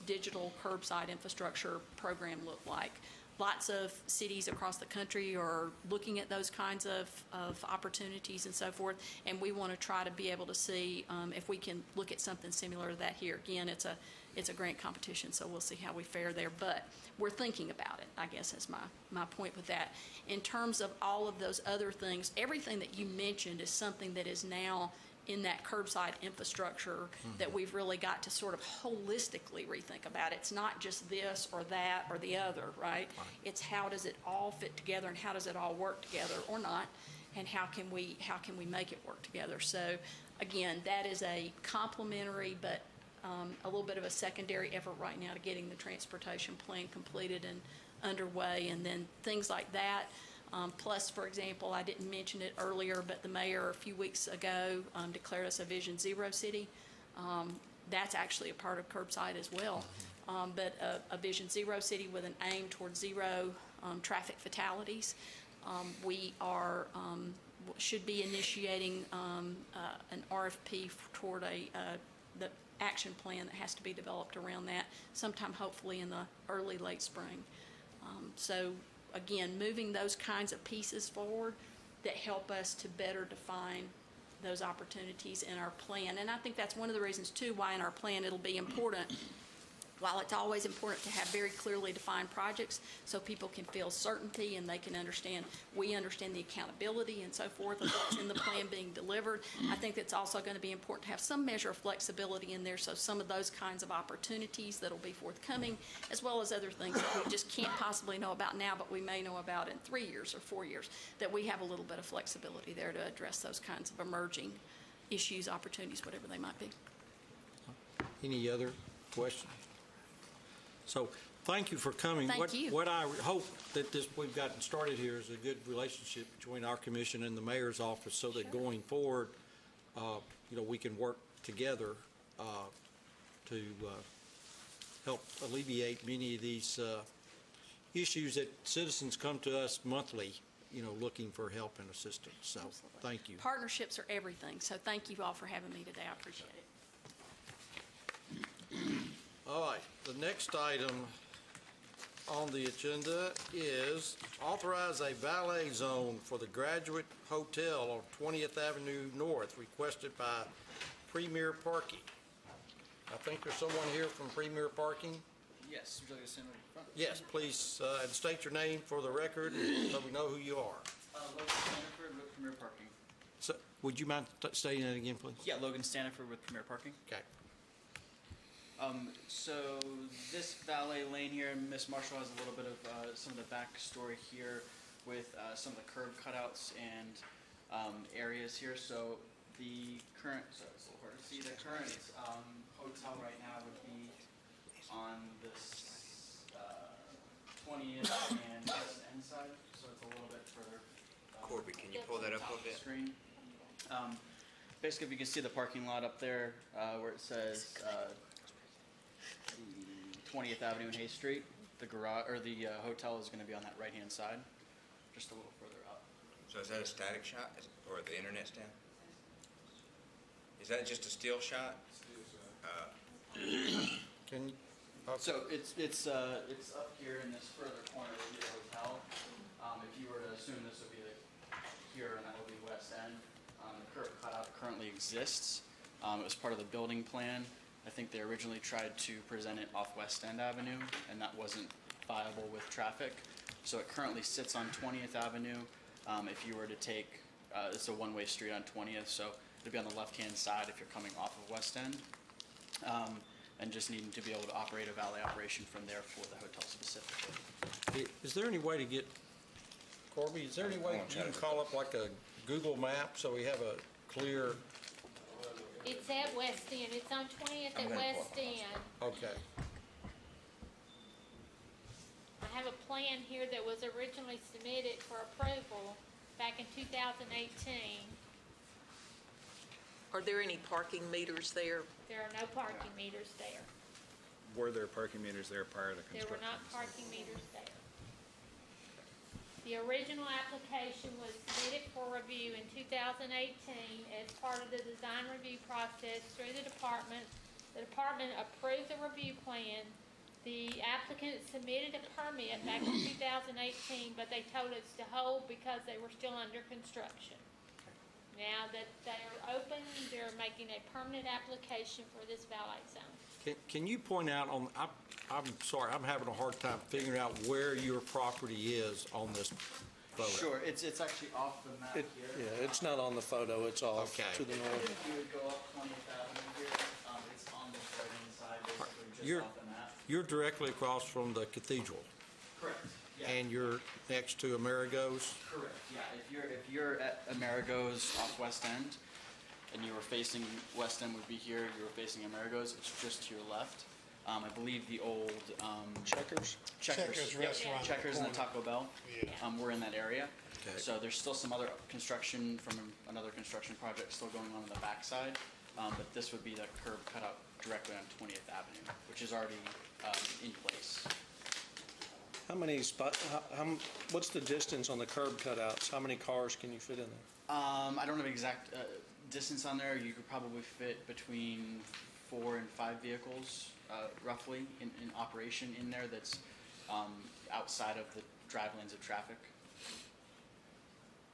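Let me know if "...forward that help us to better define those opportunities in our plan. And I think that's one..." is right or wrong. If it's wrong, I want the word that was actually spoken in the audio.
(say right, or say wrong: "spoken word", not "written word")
right.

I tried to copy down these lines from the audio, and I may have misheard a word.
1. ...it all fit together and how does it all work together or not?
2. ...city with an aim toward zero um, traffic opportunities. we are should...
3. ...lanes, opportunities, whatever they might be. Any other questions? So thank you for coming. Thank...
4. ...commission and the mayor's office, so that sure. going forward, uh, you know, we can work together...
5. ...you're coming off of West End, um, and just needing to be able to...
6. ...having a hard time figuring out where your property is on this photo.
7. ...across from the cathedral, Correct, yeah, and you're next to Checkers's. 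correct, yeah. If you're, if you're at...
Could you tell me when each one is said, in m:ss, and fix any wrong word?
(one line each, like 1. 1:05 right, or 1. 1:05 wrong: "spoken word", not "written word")
1. 0:34 right
2. 1:01 wrong: "fatalities", not "opportunities"
3. 1:55 wrong: "issues", not "lanes"
4. 2:06 right
5. 4:10 right
6. 5:16 right
7. 5:30 wrong: "Amerigo", not "Checkers".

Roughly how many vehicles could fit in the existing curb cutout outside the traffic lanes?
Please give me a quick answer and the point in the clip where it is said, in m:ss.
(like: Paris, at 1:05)
4 to 5, at 6:12.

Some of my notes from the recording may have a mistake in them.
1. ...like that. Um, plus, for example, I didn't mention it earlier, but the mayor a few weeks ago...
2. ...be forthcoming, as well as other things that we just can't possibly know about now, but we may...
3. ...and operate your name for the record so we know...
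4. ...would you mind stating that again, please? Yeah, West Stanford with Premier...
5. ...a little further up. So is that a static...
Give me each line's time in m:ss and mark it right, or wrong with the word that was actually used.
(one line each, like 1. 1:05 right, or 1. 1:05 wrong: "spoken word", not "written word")
1. 0:49 right
2. 1:44 right
3. 2:48 wrong: "state", not "operate"
4. 2:53 wrong: "Logan", not "West"
5. 3:35 right.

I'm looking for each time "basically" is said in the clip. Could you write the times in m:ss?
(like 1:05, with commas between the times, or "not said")
3:24, 5:28.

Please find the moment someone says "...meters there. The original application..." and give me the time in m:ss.
4:47.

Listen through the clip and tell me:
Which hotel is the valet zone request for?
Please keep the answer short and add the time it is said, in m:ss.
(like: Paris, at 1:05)
Graduate Hotel, at 2:36.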